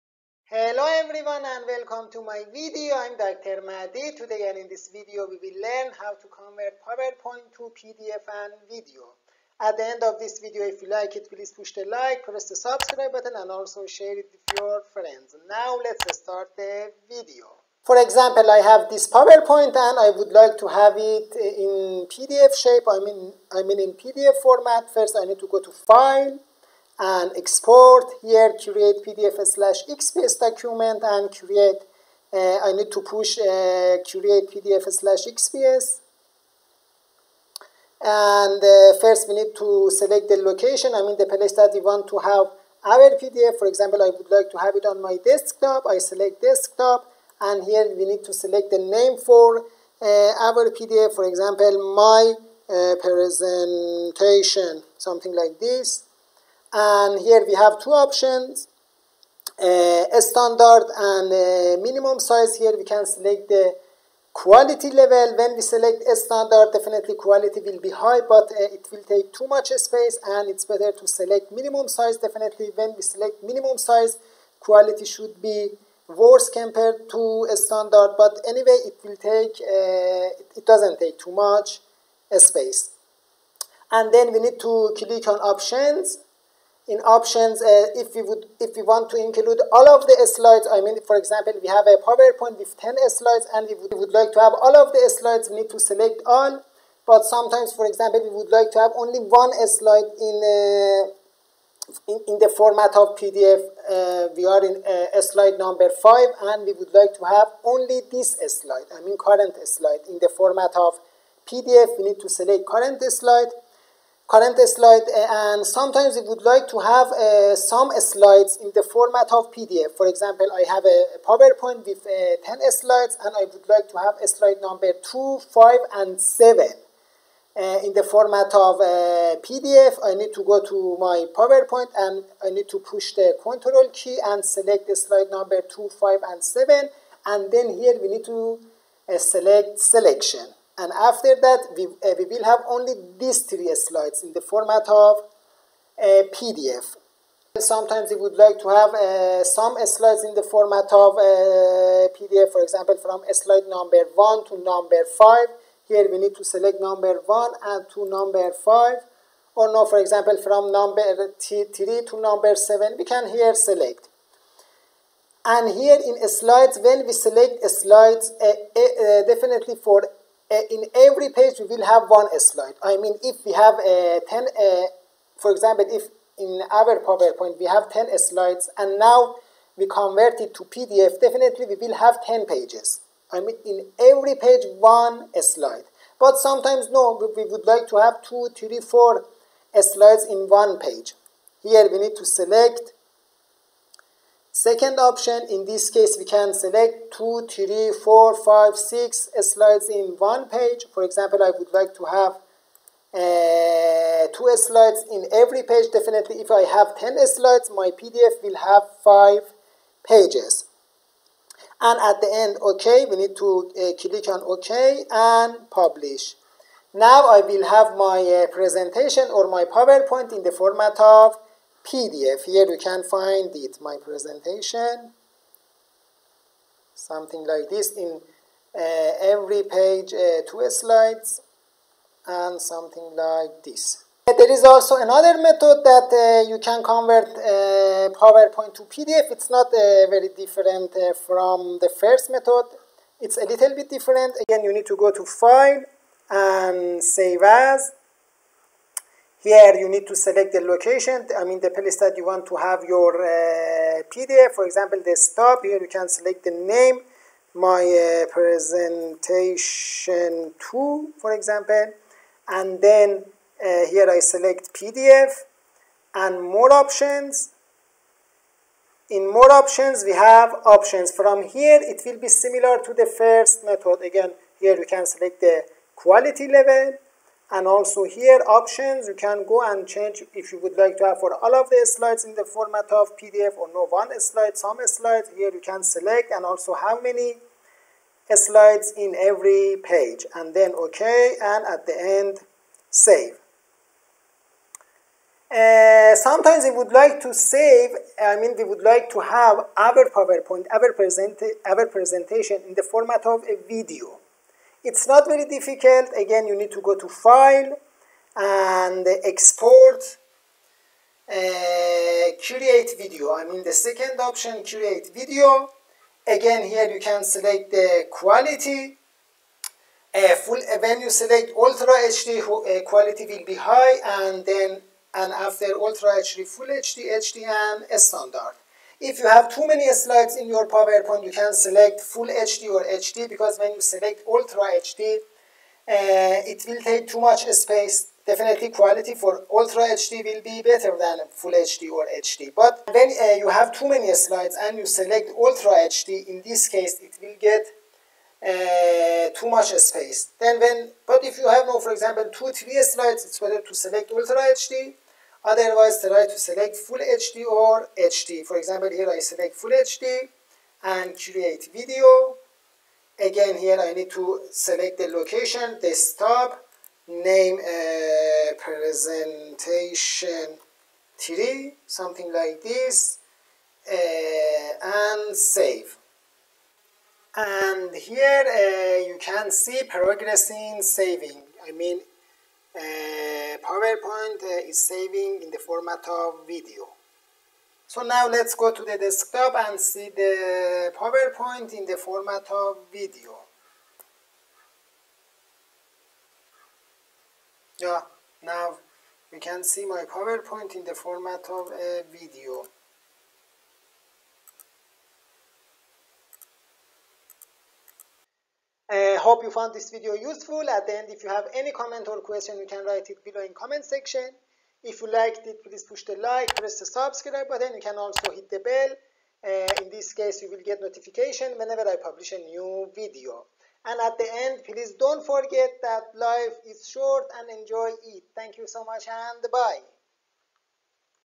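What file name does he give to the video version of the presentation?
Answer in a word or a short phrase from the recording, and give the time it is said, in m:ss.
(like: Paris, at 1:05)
presentation 3, at 6:08.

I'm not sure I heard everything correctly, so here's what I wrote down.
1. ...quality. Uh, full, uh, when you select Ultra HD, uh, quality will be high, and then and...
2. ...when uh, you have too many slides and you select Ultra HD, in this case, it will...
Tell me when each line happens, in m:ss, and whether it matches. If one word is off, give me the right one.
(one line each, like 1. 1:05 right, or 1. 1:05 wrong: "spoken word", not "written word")
1. 5:18 right
2. 5:42 right.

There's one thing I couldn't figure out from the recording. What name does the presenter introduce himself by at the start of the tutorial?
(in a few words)
Dr. Mahdi.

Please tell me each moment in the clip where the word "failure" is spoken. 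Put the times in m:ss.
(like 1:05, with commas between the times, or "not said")
not said.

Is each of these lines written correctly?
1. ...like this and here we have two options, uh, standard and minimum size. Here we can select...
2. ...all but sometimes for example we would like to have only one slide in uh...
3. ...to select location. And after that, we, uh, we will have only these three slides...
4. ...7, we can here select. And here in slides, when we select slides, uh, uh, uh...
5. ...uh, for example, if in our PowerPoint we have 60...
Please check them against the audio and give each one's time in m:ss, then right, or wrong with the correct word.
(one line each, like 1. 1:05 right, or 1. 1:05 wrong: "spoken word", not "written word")
1. 0:55 right
2. 1:36 right
3. 2:18 wrong: "selection", not "location"
4. 2:42 right
5. 2:54 wrong: "10", not "60".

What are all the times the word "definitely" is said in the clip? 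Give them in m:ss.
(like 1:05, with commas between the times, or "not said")
1:06, 1:12, 2:49, 3:01, 3:25, 5:38.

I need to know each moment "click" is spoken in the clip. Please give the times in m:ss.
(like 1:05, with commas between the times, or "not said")
1:24, 3:34.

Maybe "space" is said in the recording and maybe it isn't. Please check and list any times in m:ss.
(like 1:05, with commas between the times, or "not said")
1:09, 1:22, 5:37, 5:49.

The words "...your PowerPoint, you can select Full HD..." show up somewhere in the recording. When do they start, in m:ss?
5:30.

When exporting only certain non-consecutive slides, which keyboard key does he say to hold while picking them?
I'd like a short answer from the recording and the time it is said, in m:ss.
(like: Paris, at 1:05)
Control, at 2:13.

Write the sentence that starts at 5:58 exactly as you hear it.
For example, here I select full HD and create video.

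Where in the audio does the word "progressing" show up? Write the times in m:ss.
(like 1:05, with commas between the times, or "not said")
6:19.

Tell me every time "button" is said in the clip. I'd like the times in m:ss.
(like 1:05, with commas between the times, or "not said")
0:13, 6:57.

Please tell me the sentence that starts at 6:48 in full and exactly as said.
Uh, hope you found this video useful.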